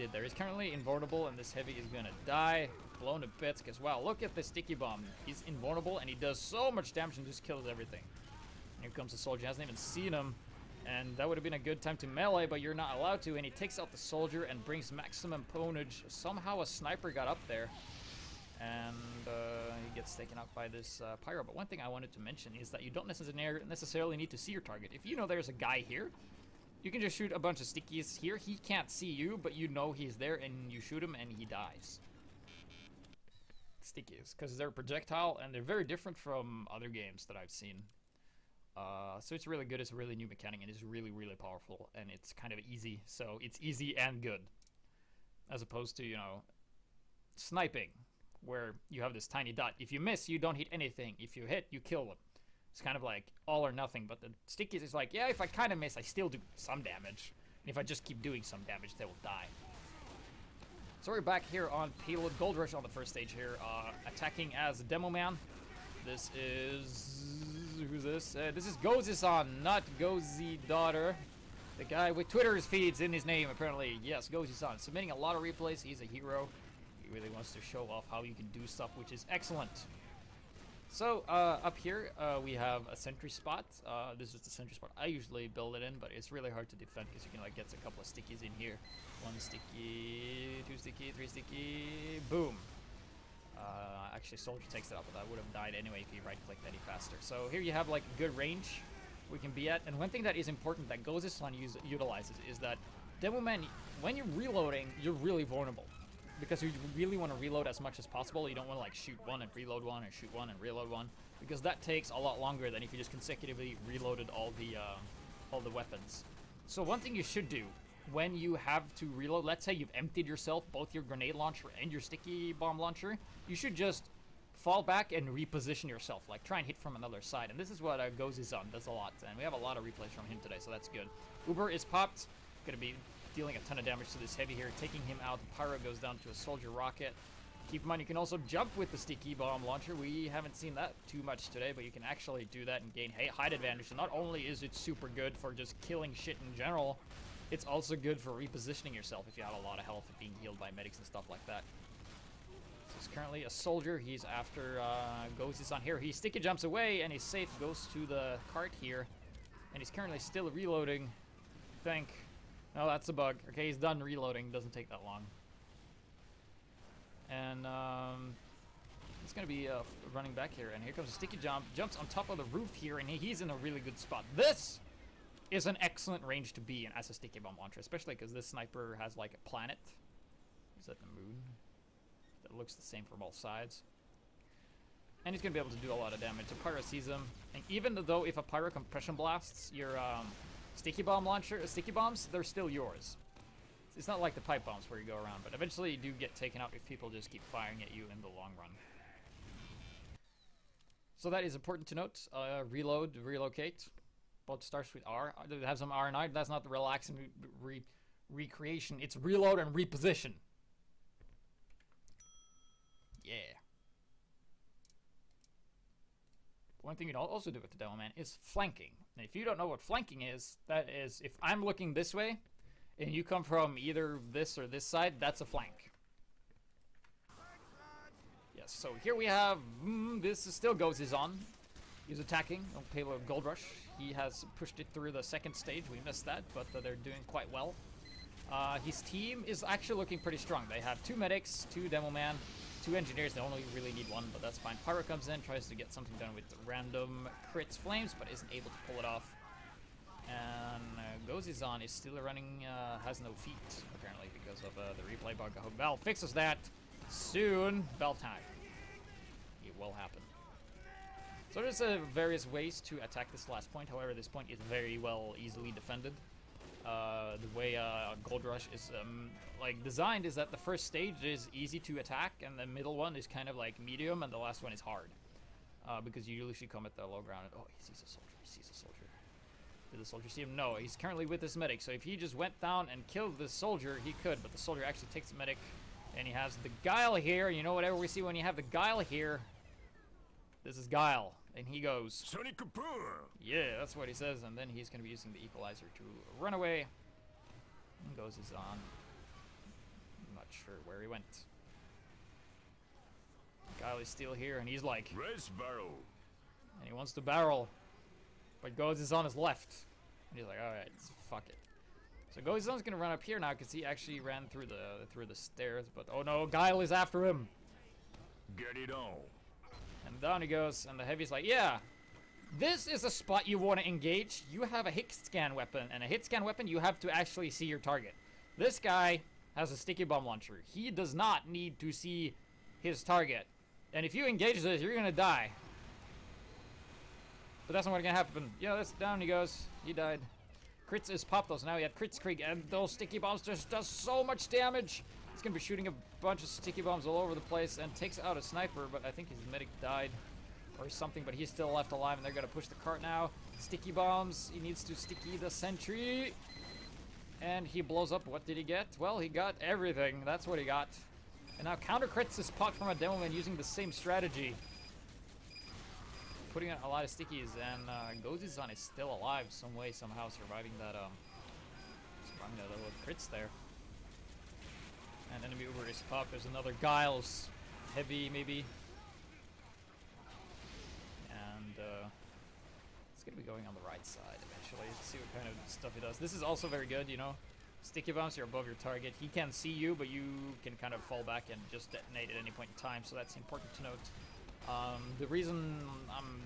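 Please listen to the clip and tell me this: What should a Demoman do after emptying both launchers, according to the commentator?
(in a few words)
Reload and reposition.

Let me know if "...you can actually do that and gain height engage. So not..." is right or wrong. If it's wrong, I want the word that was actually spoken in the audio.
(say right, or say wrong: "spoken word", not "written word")
wrong: "advantage", not "engage".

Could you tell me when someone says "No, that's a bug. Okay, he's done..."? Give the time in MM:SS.
02:42.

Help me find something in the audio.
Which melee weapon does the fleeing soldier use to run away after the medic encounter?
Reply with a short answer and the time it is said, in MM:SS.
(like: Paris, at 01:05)
Equalizer, at 04:55.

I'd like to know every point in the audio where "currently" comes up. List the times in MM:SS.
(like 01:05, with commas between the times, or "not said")
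00:00, 02:33, 02:39, 04:40.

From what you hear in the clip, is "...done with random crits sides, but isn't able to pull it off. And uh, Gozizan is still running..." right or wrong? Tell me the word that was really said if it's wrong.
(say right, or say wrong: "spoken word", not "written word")
wrong: "flames", not "sides".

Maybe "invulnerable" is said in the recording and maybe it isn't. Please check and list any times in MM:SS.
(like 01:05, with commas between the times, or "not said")
00:00, 00:05.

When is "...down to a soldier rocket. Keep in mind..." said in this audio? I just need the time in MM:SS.
02:16.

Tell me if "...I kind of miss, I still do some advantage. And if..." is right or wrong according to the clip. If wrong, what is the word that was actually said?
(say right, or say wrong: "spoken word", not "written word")
wrong: "damage", not "advantage".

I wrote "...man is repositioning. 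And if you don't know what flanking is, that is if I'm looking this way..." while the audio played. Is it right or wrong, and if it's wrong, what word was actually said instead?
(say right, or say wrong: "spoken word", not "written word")
wrong: "flanking", not "repositioning".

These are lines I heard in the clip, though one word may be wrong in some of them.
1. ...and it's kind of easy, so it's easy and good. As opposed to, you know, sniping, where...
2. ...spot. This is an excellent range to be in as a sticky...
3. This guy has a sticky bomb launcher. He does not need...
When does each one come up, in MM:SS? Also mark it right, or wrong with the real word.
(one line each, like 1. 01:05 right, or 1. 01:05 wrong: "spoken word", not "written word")
1. 00:41 right
2. 02:53 right
3. 05:28 right.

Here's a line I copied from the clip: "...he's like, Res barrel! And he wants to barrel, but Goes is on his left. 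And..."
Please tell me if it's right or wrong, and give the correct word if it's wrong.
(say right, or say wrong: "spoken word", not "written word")
right.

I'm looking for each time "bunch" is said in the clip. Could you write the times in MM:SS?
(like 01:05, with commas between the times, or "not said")
00:27, 05:46.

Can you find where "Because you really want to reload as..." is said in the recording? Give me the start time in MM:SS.
01:46.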